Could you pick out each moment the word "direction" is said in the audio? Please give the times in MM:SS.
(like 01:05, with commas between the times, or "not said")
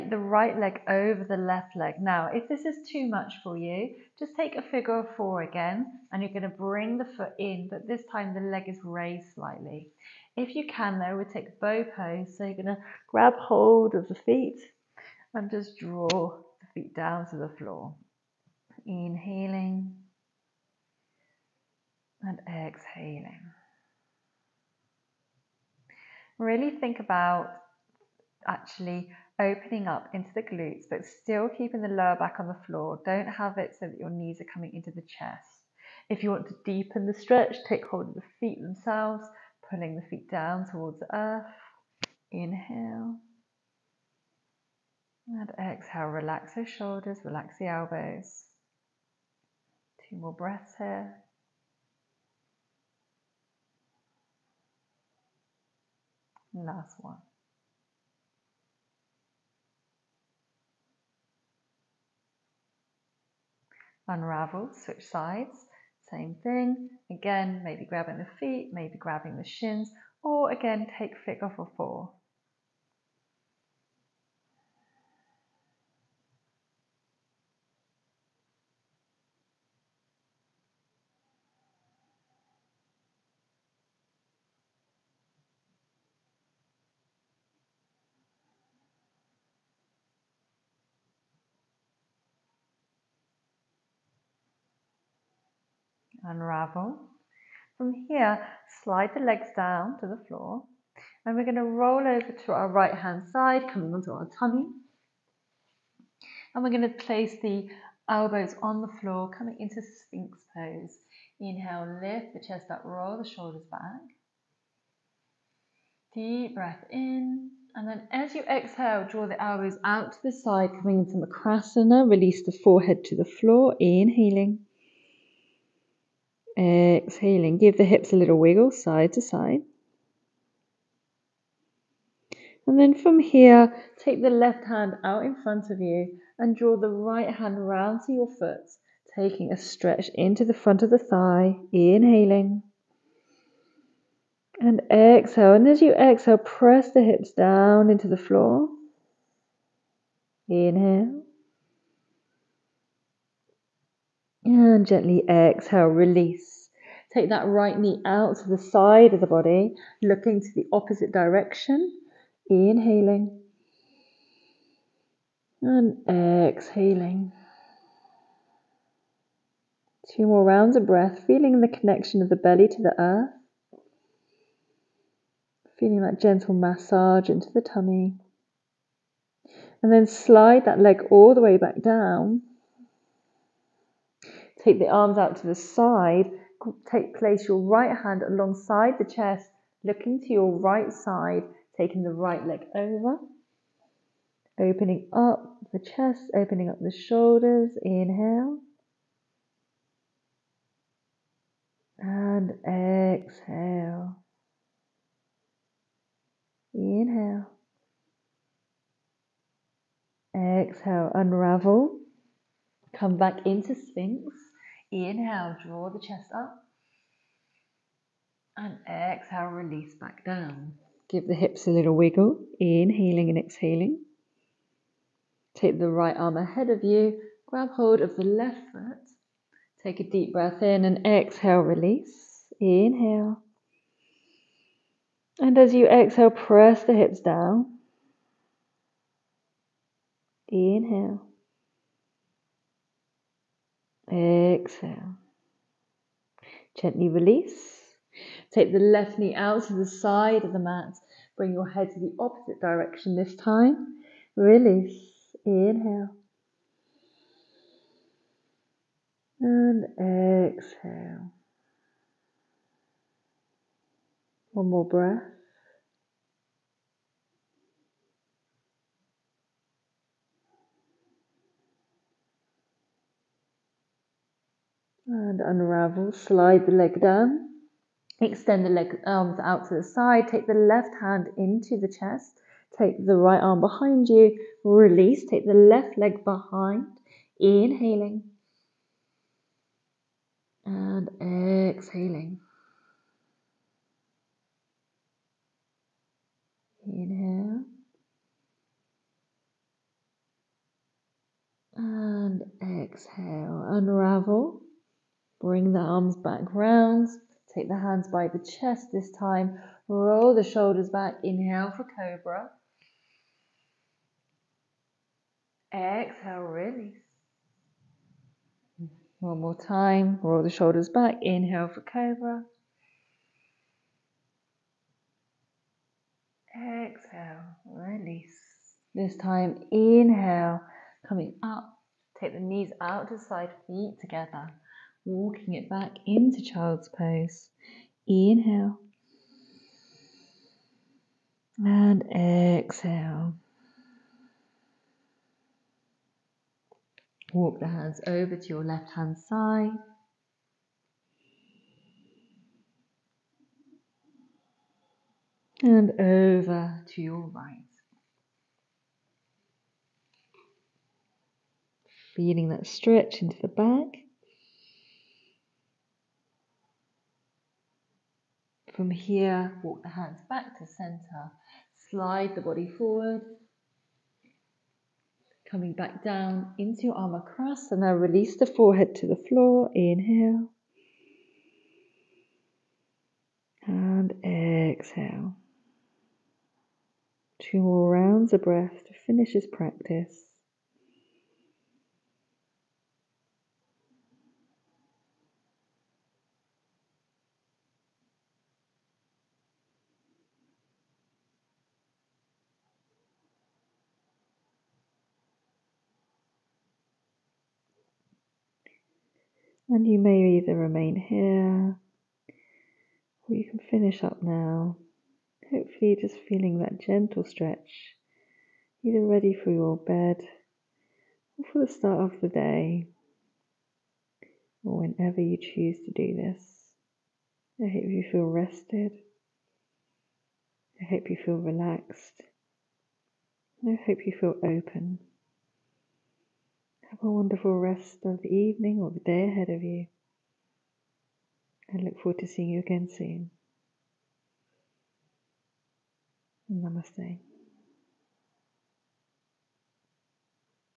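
02:41, 04:12.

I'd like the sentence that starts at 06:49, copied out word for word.
And you may either remain here or you can finish up now.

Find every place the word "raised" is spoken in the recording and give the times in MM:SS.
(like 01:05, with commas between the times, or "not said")
00:08.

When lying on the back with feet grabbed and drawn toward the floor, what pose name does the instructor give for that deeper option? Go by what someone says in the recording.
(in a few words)
Bow pose.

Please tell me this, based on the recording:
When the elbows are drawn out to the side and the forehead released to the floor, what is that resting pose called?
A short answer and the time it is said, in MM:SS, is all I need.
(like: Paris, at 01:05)
Makarasana, at 02:01.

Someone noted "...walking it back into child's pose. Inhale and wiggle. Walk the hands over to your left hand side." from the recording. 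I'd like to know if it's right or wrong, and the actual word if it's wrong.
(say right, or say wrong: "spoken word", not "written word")
wrong: "exhale", not "wiggle".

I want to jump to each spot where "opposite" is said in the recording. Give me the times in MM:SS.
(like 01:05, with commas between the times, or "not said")
02:40, 04:12.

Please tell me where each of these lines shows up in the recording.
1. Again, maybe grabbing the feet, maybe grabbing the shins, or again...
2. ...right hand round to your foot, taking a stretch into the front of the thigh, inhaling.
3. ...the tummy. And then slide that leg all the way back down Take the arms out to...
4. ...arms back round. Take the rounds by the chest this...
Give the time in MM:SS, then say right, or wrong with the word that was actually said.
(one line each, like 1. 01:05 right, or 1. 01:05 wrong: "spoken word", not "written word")
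1. 01:07 right
2. 02:16 right
3. 02:57 right
4. 05:05 wrong: "hands", not "rounds".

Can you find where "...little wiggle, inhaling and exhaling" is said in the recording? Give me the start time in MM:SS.
03:41.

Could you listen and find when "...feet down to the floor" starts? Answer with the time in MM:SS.
00:16.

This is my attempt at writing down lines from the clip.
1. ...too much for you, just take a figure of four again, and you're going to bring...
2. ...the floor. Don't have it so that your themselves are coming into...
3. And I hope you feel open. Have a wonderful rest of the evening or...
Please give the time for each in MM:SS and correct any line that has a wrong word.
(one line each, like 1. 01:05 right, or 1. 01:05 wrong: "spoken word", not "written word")
1. 00:02 right
2. 00:32 wrong: "knees", not "themselves"
3. 07:13 right.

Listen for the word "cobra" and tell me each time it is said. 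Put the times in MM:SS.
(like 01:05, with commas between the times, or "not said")
05:11, 05:21.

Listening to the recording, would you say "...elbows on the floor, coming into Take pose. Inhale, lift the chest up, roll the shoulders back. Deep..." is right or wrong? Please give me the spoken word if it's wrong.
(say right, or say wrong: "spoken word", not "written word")
wrong: "Sphinx", not "Take".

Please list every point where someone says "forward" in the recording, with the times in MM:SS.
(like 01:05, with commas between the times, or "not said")
06:12, 07:22.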